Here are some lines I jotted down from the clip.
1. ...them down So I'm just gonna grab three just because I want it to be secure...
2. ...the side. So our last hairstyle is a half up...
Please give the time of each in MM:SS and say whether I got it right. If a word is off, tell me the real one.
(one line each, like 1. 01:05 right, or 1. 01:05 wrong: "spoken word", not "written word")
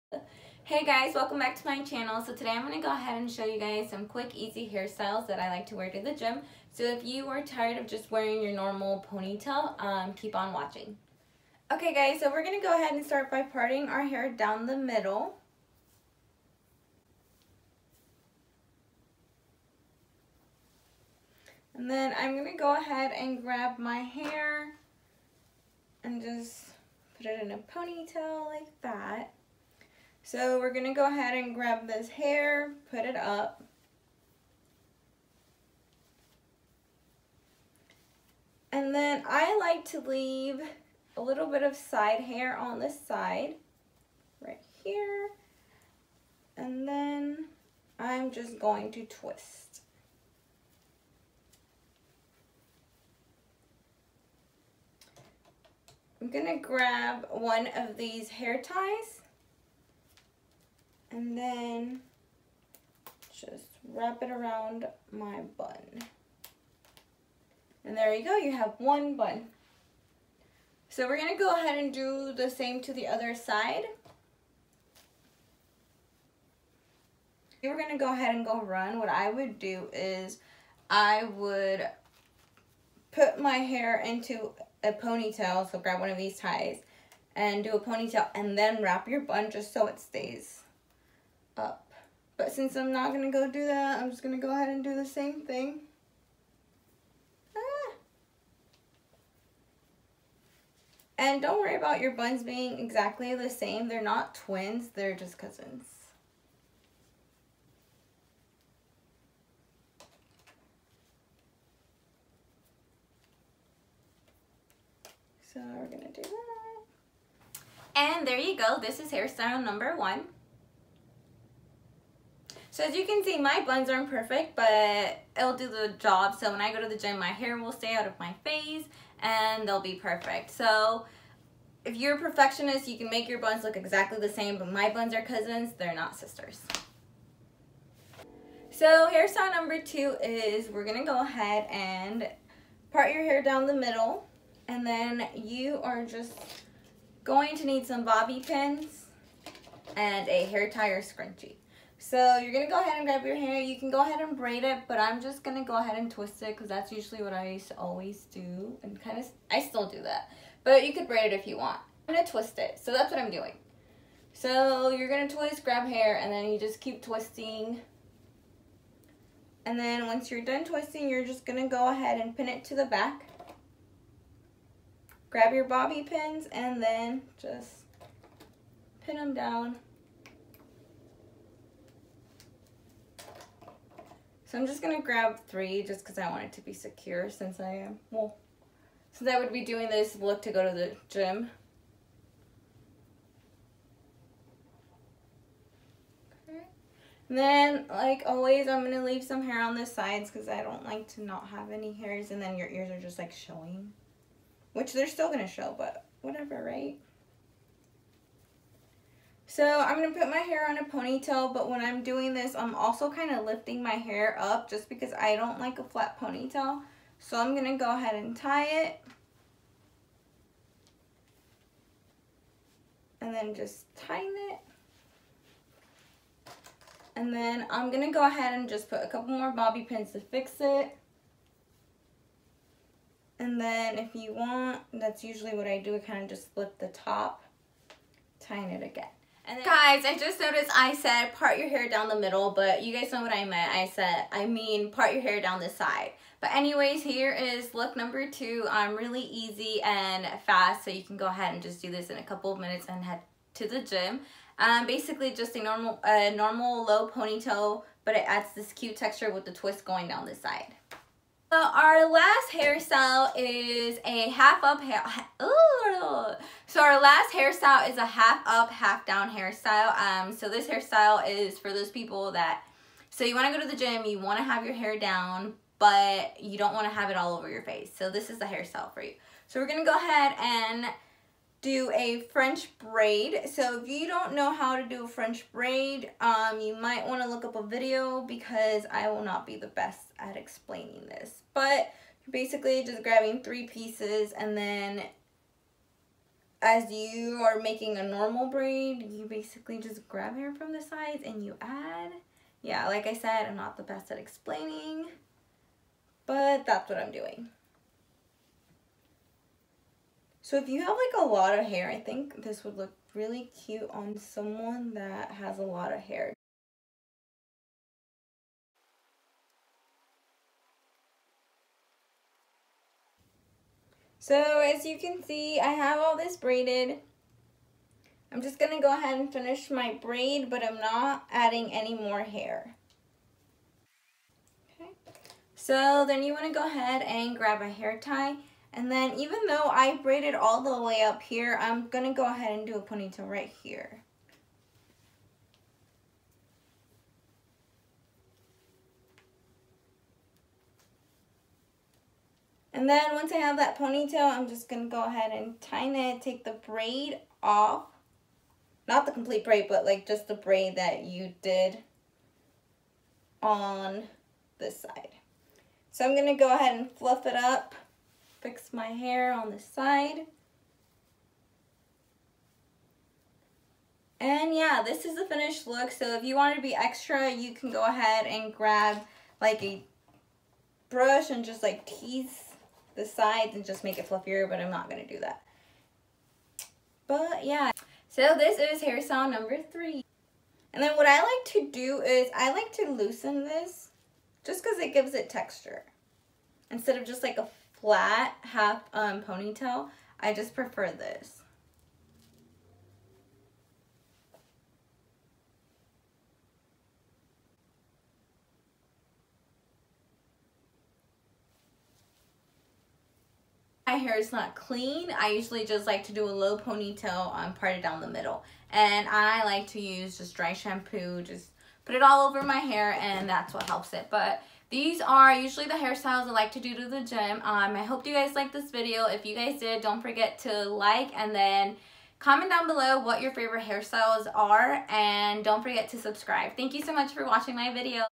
1. 02:59 right
2. 04:20 right.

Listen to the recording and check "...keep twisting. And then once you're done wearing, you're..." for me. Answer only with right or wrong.
wrong.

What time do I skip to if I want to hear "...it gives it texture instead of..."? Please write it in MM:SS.
06:34.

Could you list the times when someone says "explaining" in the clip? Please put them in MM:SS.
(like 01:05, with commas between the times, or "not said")
04:50, 05:04.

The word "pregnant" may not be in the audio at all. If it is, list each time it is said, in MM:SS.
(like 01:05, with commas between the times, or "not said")
not said.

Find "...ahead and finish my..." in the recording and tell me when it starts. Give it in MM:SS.
05:28.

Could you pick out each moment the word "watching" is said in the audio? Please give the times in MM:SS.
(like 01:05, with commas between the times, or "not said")
00:10, 07:17.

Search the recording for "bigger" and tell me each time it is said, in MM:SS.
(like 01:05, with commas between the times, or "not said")
not said.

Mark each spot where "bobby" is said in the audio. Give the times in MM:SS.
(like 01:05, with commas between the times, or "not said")
02:28, 02:55, 03:49.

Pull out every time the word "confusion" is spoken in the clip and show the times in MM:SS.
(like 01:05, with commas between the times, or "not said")
not said.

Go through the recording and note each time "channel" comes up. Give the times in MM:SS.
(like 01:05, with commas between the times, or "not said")
00:01.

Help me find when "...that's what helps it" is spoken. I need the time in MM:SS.
07:03.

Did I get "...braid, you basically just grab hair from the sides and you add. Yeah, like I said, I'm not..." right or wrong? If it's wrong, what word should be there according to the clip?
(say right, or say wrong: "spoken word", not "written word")
right.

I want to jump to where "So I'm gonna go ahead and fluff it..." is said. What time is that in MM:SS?
06:05.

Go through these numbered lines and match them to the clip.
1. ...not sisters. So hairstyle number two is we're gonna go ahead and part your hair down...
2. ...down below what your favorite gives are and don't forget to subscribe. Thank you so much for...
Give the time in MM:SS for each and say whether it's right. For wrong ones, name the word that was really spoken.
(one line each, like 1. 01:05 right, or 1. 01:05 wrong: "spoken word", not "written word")
1. 02:15 right
2. 07:12 wrong: "hairstyles", not "gives".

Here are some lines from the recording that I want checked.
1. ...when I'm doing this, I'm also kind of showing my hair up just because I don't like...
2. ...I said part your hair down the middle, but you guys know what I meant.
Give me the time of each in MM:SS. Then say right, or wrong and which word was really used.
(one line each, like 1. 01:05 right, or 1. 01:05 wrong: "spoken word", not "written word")
1. 03:31 wrong: "lifting", not "showing"
2. 04:00 right.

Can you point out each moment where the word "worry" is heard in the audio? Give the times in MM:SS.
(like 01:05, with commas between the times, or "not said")
01:41.